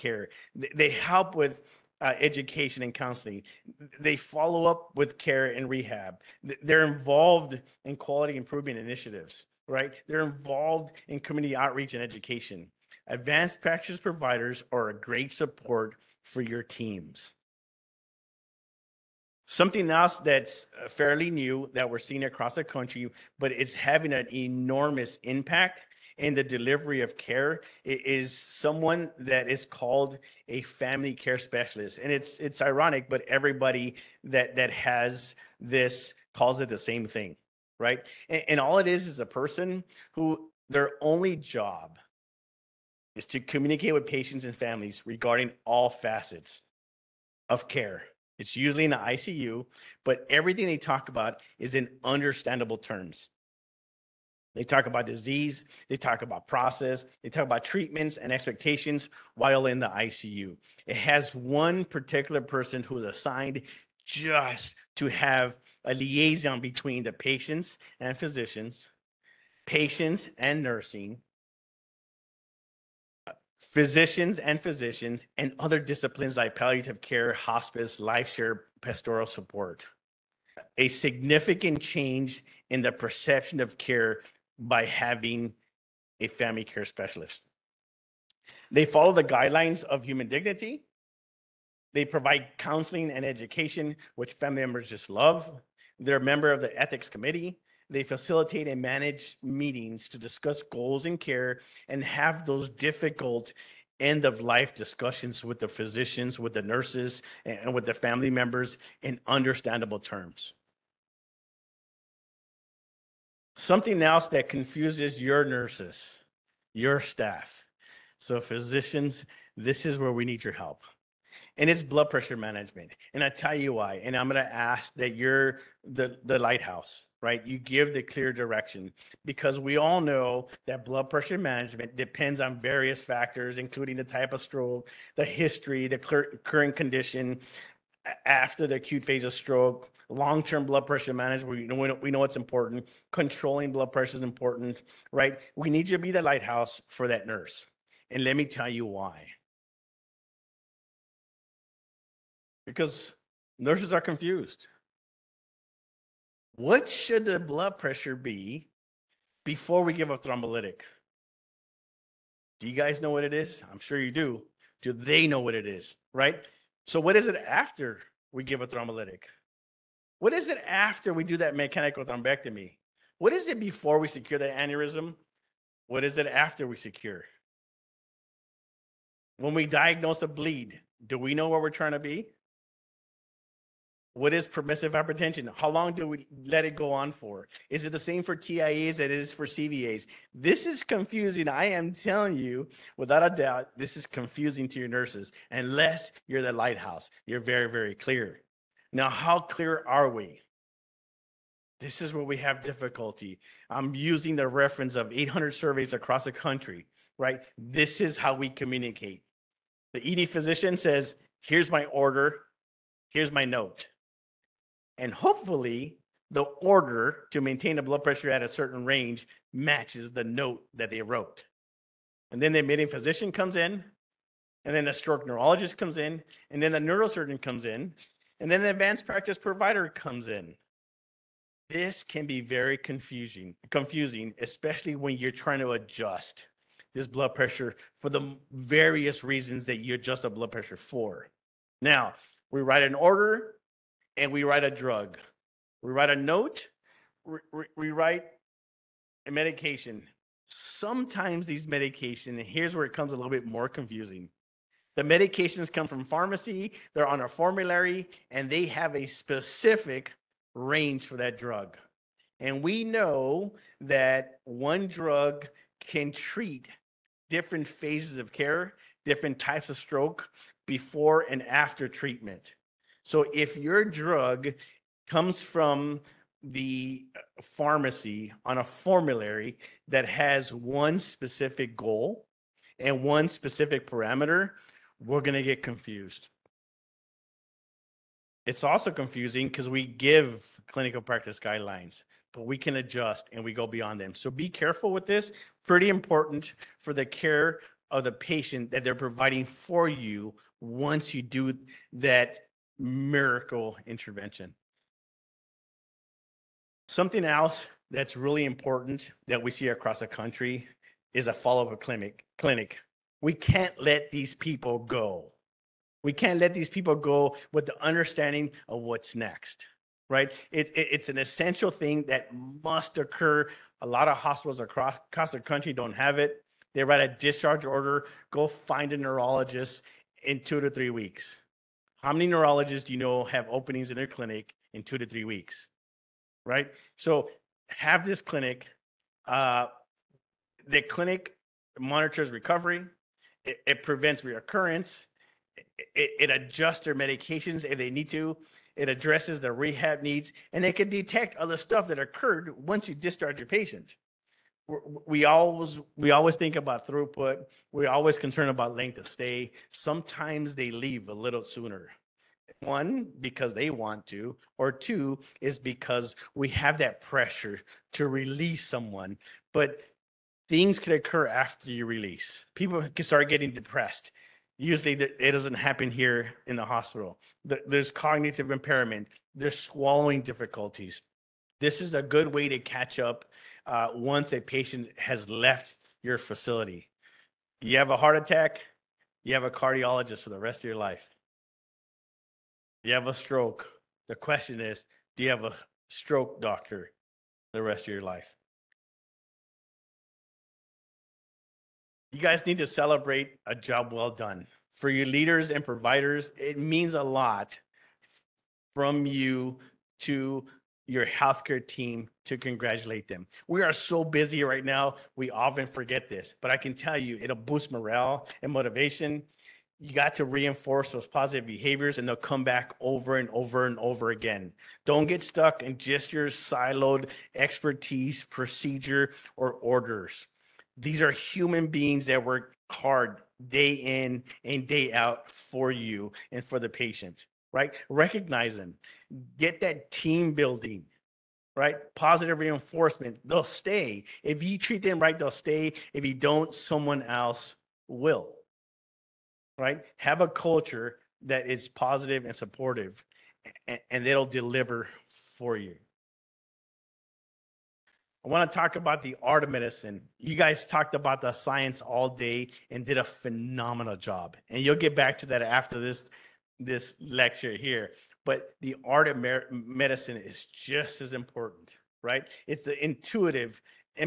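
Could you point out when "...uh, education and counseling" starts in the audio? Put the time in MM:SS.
00:01.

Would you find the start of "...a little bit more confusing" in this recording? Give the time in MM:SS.
04:13.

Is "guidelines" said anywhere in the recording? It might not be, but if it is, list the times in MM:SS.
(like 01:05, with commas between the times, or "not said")
01:29, 04:51.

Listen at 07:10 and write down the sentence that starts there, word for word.
These are human beings that work hard day in and day out for you and for the patient right?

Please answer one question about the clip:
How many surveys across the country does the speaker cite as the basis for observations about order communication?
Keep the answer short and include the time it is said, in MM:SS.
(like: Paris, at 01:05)
800, at 03:25.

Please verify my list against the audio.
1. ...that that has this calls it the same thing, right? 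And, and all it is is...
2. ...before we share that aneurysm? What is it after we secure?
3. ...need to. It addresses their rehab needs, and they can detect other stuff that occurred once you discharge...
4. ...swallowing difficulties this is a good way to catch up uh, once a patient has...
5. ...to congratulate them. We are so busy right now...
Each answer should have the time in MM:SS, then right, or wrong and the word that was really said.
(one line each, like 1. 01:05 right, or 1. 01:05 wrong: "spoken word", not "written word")
1. 00:34 right
2. 02:53 wrong: "secure", not "share"
3. 05:47 right
4. 06:19 right
5. 06:52 right.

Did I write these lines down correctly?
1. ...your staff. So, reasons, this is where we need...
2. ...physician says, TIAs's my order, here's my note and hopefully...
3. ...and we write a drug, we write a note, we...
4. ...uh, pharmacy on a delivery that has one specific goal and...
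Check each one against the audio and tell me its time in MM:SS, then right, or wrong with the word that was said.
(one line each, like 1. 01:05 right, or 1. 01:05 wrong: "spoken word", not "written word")
1. 01:56 wrong: "physicians", not "reasons"
2. 03:30 wrong: "Here", not "TIAs"
3. 04:04 right
4. 04:37 wrong: "formulary", not "delivery".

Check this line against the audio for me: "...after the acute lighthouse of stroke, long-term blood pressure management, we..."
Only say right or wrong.
wrong.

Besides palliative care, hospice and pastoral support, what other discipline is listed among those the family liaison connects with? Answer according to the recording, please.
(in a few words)
Life share.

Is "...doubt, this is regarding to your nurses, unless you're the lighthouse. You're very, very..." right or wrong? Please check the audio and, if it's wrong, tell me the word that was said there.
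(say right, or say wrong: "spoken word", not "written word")
wrong: "confusing", not "regarding".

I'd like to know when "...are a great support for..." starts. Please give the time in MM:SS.
00:14.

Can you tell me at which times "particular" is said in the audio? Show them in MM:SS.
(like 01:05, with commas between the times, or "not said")
01:01.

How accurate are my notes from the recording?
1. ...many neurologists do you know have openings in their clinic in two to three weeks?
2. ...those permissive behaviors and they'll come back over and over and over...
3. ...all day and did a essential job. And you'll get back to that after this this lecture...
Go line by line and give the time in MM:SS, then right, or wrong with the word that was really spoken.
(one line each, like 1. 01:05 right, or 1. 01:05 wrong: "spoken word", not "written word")
1. 05:32 right
2. 07:00 wrong: "positive", not "permissive"
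3. 07:41 wrong: "phenomenal", not "essential".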